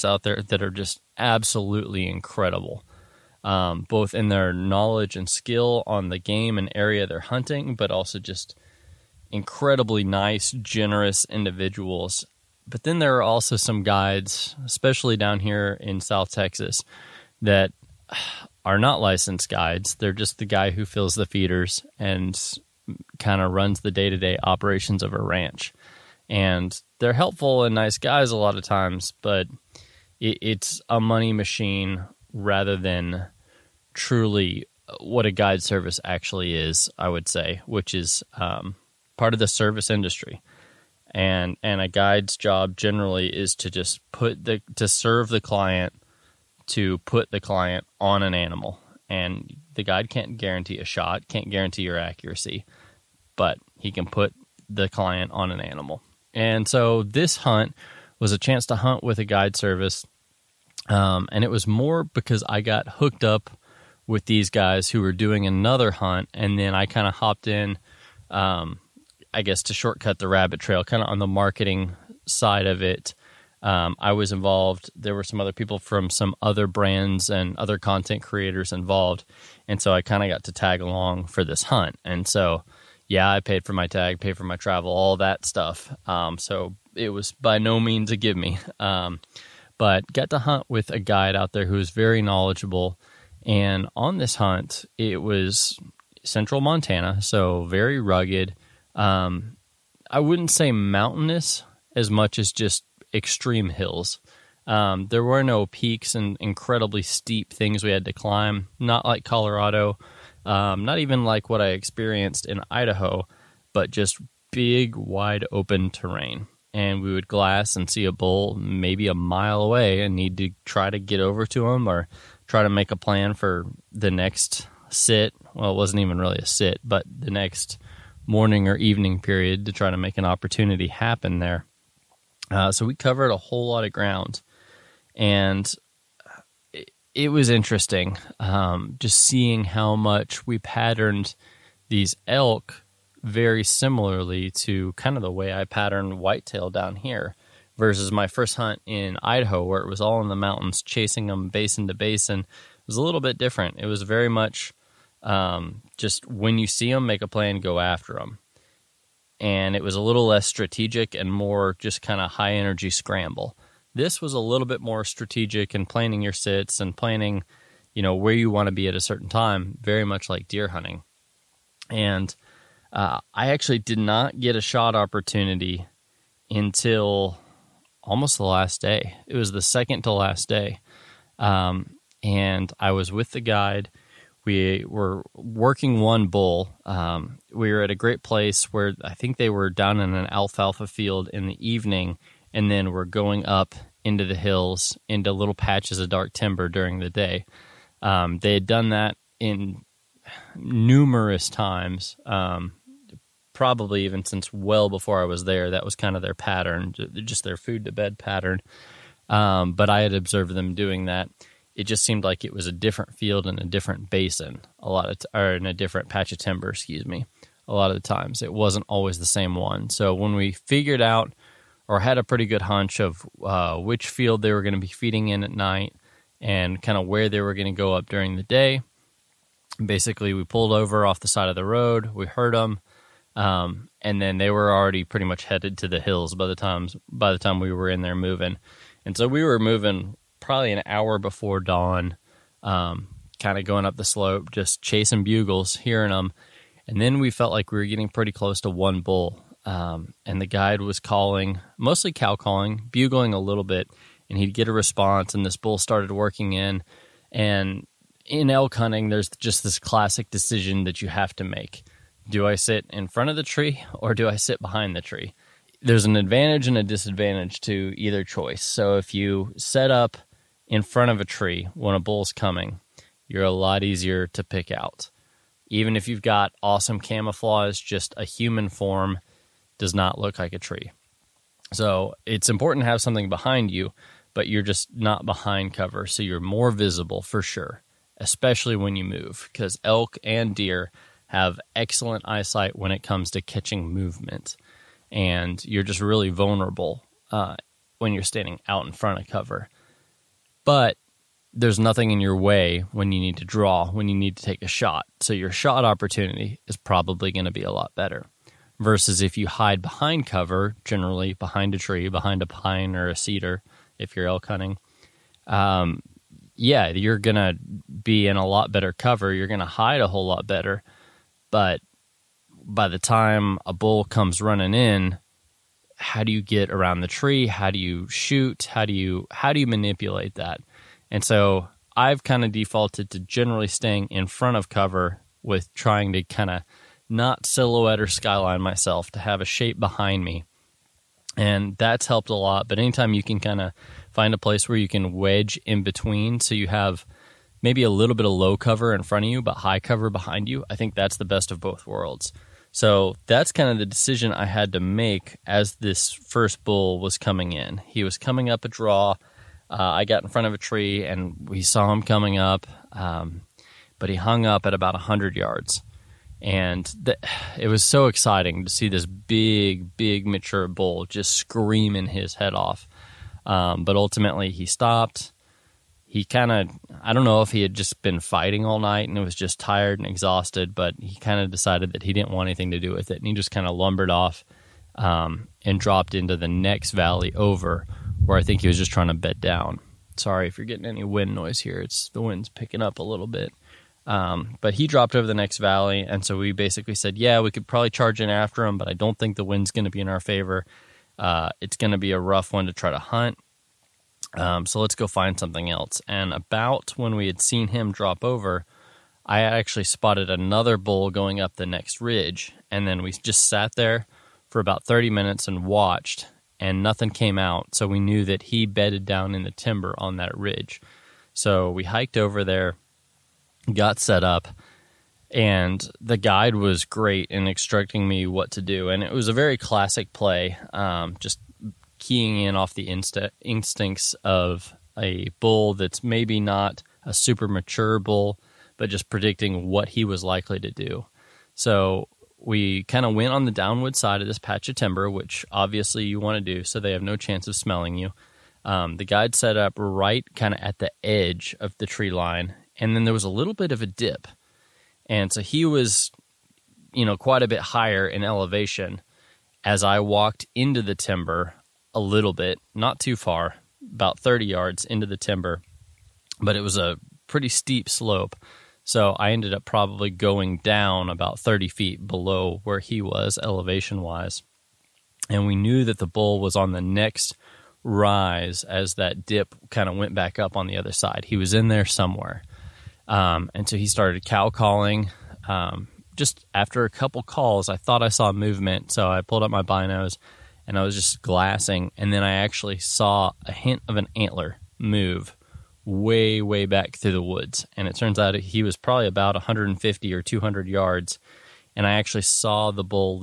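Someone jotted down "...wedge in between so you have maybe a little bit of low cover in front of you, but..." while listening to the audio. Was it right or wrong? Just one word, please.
right.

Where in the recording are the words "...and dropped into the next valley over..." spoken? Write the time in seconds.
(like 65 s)
385 s.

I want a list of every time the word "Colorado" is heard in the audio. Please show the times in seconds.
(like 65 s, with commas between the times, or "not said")
109 s.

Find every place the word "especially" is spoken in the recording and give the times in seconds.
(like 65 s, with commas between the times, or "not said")
14 s, 288 s.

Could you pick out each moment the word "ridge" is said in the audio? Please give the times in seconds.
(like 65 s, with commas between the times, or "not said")
412 s, 420 s.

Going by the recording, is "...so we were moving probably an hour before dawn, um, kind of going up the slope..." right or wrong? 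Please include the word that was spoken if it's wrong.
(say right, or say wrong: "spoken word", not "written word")
right.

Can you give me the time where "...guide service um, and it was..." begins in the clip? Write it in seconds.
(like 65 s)
59 s.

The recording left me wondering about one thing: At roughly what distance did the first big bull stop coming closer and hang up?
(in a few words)
100 yards.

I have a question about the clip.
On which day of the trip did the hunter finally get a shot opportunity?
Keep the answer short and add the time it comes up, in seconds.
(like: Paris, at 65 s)
Second to last day, at 179 s.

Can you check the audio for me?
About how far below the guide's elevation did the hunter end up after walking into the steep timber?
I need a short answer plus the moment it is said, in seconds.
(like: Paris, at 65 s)
30 feet, at 471 s.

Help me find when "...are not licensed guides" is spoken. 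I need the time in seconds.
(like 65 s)
18 s.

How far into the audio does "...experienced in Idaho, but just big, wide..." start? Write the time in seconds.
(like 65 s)
111 s.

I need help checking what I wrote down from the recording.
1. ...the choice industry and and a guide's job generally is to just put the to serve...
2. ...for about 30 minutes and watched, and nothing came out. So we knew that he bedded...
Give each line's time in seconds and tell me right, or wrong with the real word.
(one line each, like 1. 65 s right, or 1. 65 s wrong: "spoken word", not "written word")
1. 39 s wrong: "service", not "choice"
2. 414 s right.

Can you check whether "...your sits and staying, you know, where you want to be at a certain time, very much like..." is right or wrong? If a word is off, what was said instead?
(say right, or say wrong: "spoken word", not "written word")
wrong: "planning", not "staying".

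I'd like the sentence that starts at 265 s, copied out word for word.
There's an advantage and a disadvantage to either choice.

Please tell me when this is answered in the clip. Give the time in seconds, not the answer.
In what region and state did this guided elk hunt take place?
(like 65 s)
96 s.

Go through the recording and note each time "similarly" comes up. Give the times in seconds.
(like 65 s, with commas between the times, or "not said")
143 s.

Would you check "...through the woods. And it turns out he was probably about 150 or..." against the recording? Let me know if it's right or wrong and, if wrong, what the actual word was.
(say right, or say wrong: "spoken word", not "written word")
right.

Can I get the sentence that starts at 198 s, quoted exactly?
Um, they had done that in numerous times, um, probably even since well before I was there.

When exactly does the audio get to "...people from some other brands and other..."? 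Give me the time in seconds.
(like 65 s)
75 s.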